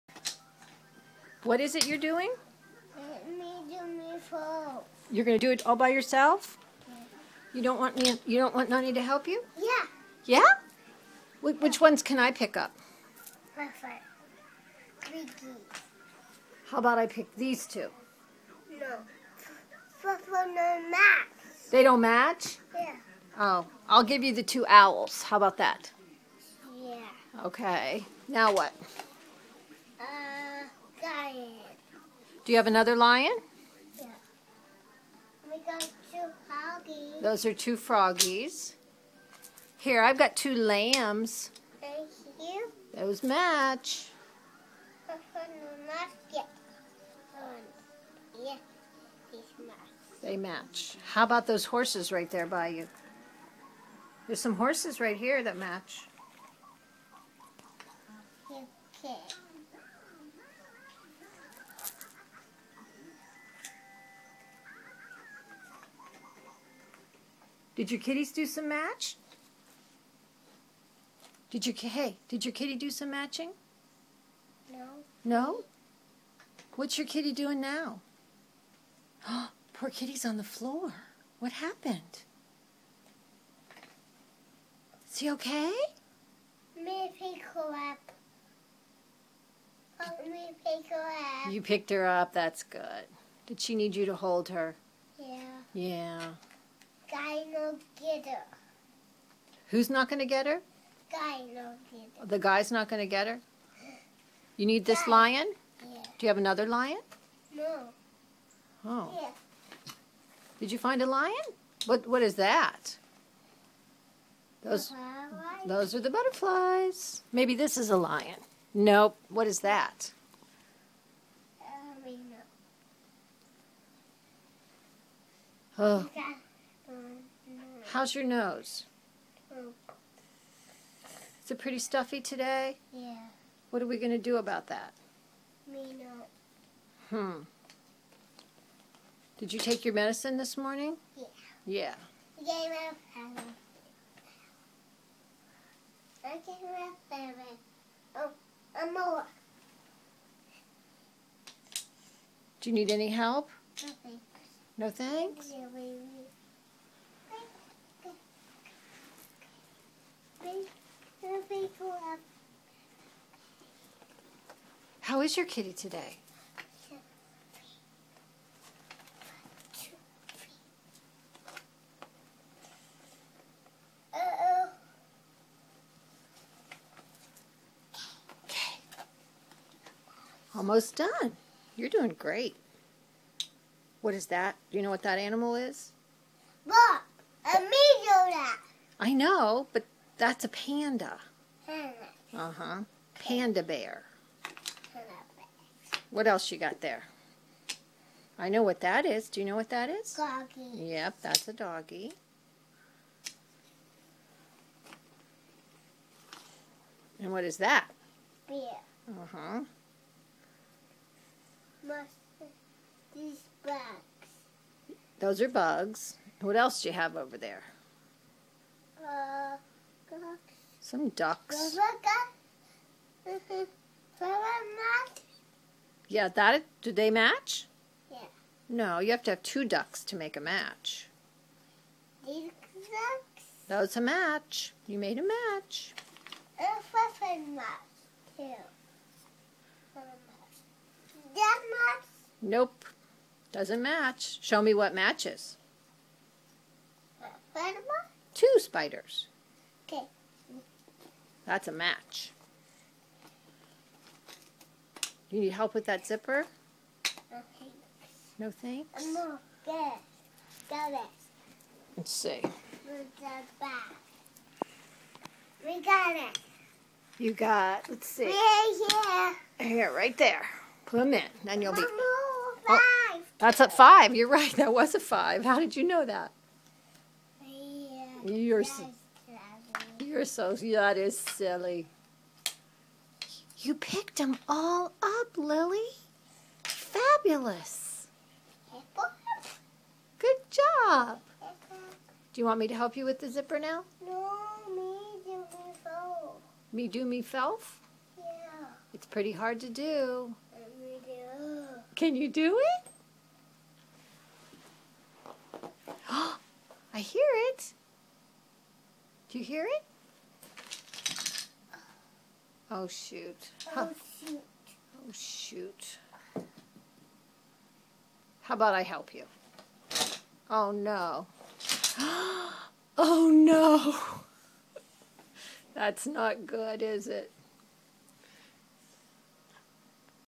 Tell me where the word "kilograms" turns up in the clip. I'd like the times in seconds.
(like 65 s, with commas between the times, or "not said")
not said.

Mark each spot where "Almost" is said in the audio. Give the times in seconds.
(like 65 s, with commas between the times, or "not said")
180 s.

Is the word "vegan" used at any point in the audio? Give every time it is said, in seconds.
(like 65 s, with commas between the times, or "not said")
not said.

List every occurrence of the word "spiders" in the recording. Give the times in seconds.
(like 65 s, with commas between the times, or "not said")
248 s.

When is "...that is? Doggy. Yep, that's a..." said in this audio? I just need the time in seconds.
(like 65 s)
199 s.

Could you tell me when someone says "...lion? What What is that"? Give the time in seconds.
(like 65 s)
111 s.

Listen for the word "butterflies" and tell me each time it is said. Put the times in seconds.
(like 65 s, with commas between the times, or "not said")
116 s.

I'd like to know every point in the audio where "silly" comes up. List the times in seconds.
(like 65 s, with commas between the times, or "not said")
281 s.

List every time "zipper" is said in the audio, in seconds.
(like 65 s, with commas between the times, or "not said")
256 s, 293 s.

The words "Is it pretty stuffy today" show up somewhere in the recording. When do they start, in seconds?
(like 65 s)
131 s.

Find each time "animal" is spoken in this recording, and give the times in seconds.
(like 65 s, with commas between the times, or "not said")
185 s.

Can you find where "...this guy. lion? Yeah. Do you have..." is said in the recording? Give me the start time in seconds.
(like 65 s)
104 s.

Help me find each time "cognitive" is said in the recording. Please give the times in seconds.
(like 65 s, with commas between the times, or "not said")
not said.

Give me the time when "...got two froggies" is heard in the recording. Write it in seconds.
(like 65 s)
35 s.